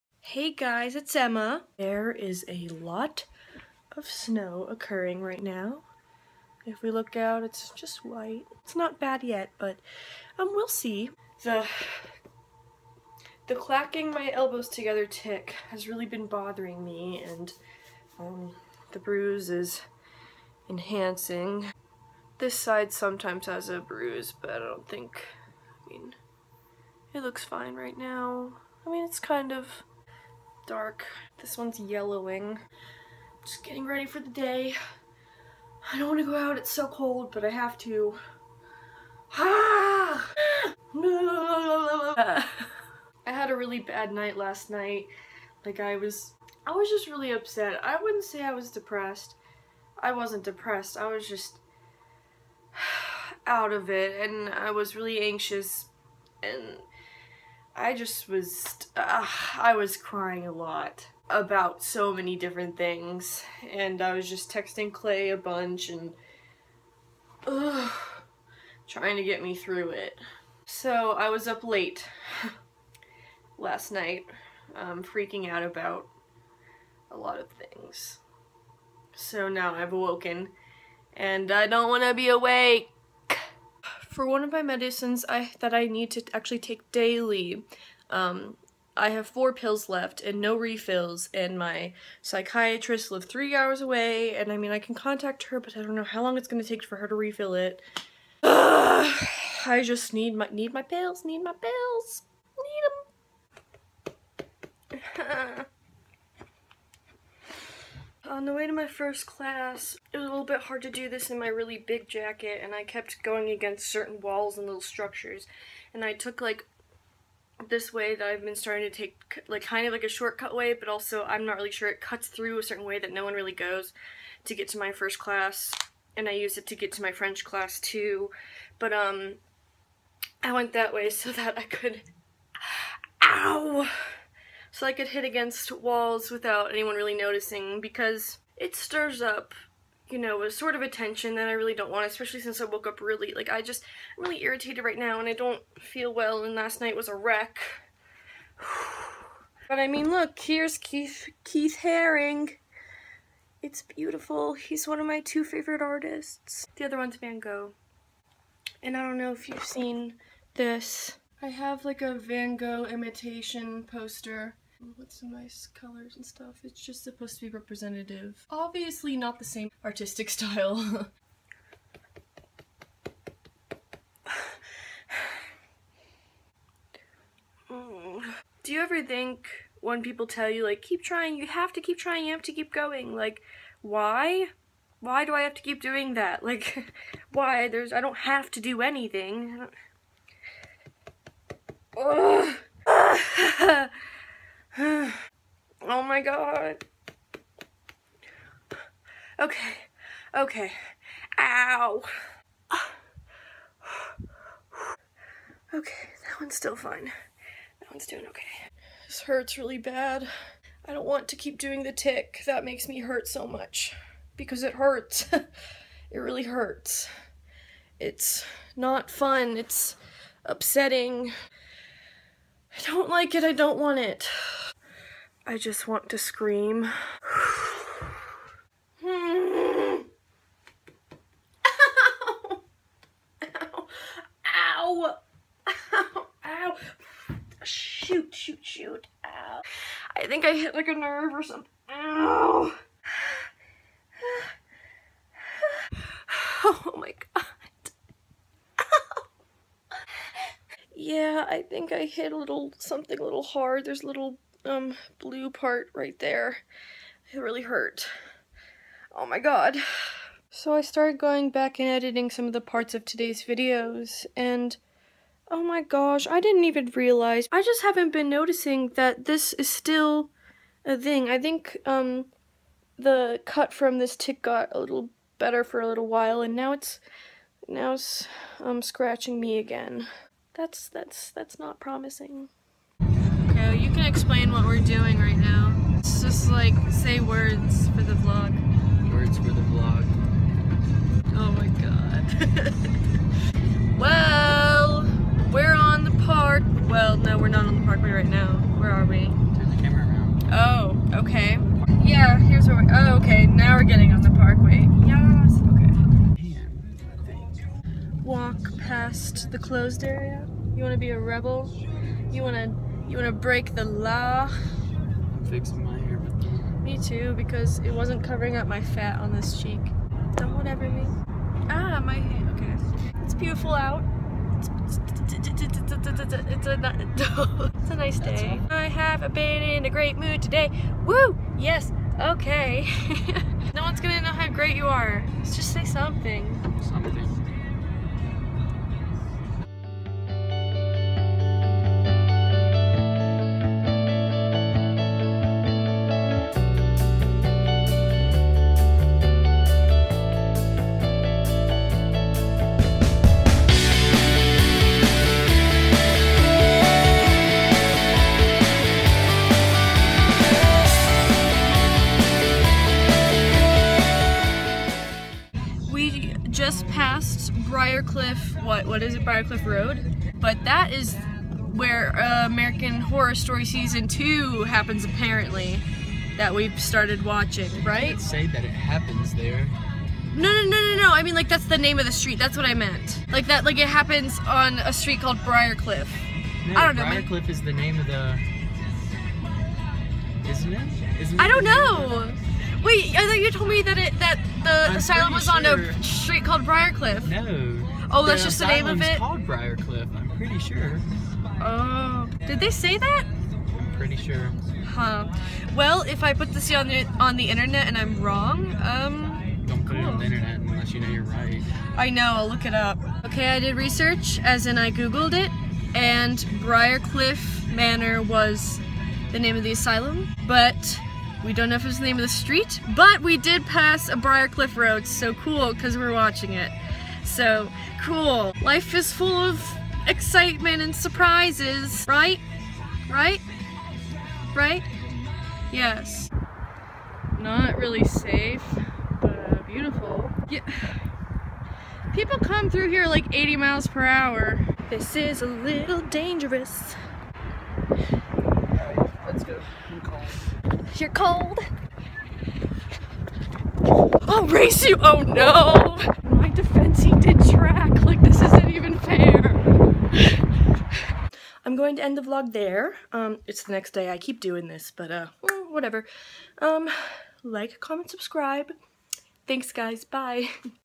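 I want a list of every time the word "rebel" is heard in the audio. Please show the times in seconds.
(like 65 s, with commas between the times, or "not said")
311 s.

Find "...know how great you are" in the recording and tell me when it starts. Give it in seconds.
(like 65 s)
334 s.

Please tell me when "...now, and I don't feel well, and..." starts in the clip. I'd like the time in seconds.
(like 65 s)
144 s.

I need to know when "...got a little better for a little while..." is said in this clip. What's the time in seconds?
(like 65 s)
274 s.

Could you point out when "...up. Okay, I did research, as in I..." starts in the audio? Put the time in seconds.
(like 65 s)
412 s.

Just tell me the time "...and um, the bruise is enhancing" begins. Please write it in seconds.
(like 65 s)
17 s.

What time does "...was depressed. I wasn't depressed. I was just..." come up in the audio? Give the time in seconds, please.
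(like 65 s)
48 s.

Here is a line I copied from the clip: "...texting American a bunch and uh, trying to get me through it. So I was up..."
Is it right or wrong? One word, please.
wrong.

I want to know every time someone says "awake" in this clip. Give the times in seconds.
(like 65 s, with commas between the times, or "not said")
82 s.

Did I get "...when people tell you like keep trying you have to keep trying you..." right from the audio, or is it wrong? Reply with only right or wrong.
right.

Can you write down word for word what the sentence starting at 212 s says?
That makes me hurt so much because it hurts.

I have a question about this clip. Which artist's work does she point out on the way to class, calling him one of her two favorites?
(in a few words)
Keith Haring.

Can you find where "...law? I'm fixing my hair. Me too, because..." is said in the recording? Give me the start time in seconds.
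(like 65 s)
313 s.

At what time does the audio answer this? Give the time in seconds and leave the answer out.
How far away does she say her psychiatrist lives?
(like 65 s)
93 s.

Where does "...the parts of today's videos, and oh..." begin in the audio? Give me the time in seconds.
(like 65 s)
262 s.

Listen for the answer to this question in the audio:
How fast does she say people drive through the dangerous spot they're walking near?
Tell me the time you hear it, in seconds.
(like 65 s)
443 s.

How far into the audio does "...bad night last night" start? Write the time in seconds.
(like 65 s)
43 s.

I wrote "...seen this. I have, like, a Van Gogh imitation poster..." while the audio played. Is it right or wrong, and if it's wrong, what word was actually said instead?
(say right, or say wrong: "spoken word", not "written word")
right.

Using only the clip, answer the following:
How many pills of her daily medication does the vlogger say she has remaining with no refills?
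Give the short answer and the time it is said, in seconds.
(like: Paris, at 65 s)
4, at 89 s.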